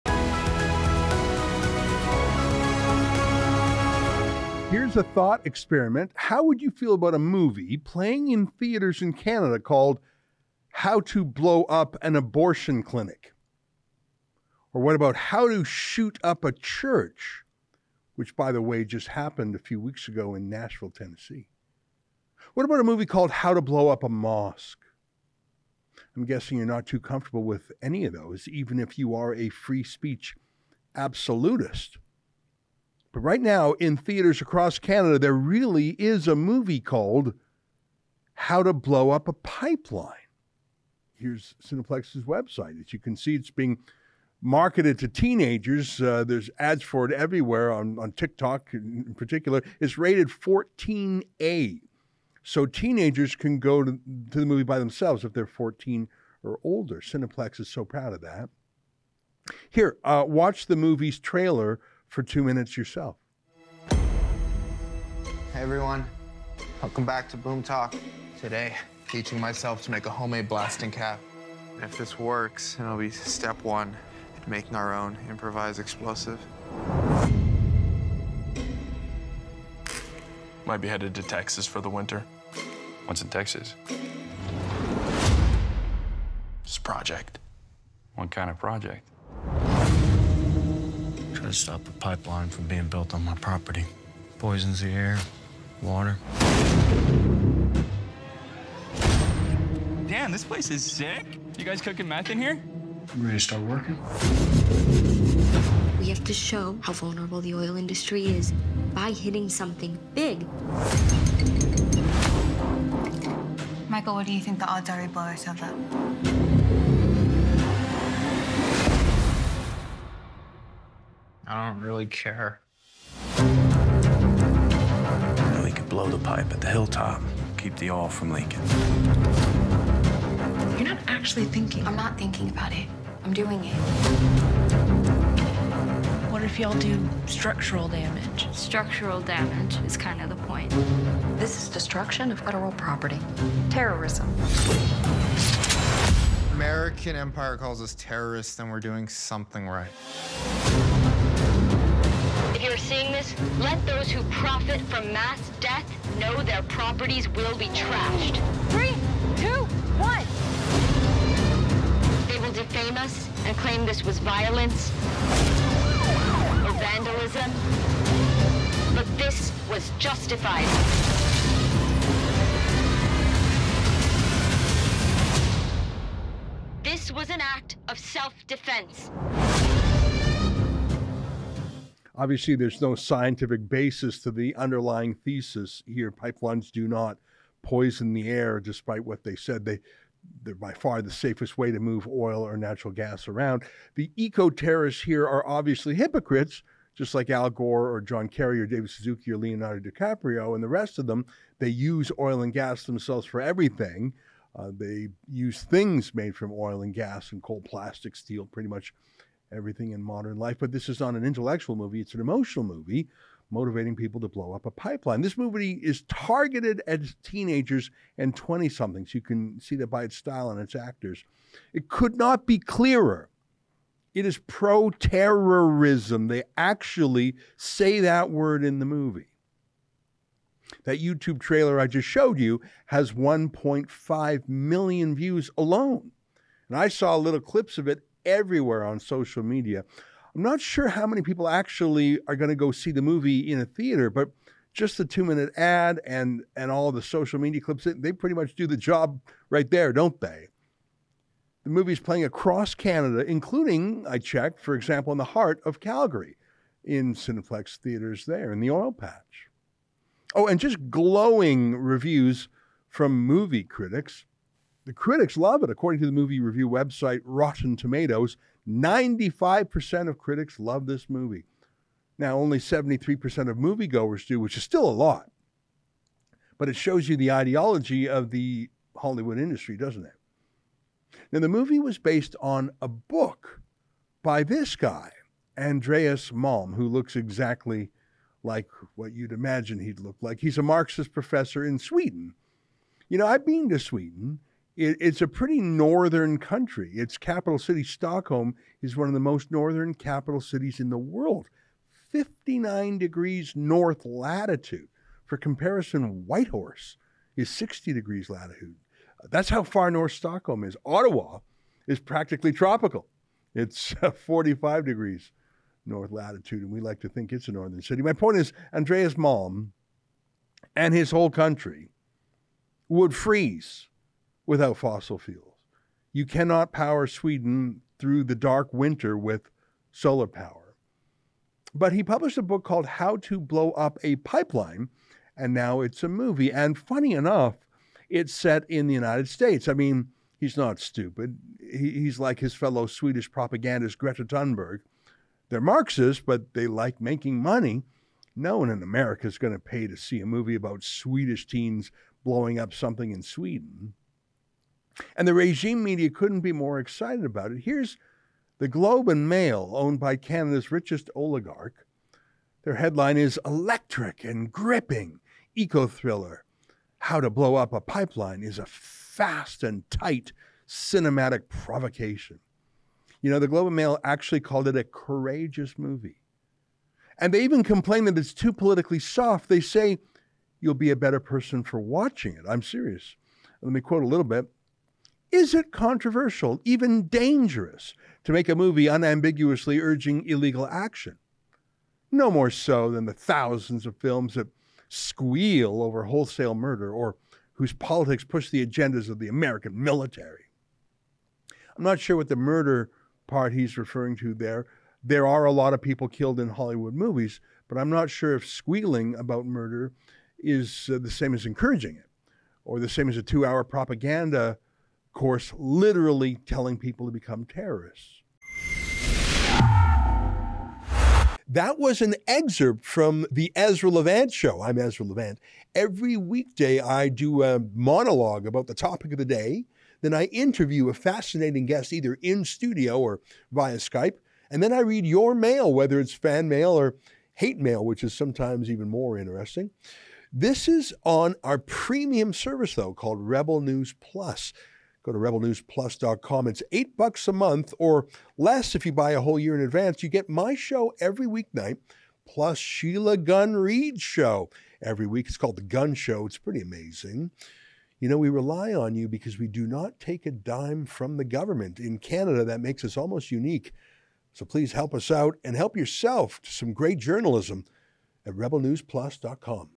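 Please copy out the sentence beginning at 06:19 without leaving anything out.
They say, You'll be a better person for watching it.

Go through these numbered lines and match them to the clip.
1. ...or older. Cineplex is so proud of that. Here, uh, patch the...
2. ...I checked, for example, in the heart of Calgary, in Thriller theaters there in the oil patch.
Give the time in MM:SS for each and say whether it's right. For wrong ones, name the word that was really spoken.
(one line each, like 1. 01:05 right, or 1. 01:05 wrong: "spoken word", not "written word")
1. 00:56 wrong: "watch", not "patch"
2. 04:14 wrong: "Cineplex", not "Thriller".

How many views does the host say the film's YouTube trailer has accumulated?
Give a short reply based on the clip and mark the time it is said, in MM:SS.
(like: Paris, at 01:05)
1.5 million, at 03:53.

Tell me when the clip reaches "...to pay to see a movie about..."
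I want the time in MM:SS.
05:49.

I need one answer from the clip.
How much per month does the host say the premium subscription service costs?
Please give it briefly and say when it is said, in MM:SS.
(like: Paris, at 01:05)
$8, at 07:26.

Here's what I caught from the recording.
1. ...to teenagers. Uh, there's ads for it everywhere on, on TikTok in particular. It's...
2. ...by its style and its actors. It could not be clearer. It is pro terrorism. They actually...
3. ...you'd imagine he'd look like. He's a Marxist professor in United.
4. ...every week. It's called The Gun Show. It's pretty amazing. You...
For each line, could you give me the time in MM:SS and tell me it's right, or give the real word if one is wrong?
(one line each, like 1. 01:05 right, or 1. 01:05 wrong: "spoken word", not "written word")
1. 00:44 right
2. 03:39 right
3. 04:49 wrong: "Sweden", not "United"
4. 07:34 right.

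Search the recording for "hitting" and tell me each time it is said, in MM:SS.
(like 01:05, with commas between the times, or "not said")
01:49.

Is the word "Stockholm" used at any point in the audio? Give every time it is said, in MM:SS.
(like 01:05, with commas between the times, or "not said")
04:57, 05:10.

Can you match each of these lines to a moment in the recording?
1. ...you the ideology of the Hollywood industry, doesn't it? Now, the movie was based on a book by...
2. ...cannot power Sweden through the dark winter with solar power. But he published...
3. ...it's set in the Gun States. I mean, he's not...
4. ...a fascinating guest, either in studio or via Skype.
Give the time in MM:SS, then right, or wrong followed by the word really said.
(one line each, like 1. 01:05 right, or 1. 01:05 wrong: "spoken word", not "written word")
1. 04:37 right
2. 05:26 right
3. 05:38 wrong: "United", not "Gun"
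4. 07:10 right.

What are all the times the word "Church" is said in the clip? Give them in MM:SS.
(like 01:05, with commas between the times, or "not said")
00:16.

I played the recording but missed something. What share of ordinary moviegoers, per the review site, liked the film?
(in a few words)
73%.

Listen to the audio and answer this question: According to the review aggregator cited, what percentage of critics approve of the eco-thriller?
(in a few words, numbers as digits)
95%.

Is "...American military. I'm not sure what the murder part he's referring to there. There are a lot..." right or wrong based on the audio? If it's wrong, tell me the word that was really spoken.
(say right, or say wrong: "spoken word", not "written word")
right.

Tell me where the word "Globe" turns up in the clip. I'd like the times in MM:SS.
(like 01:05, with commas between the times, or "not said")
05:58, 06:13.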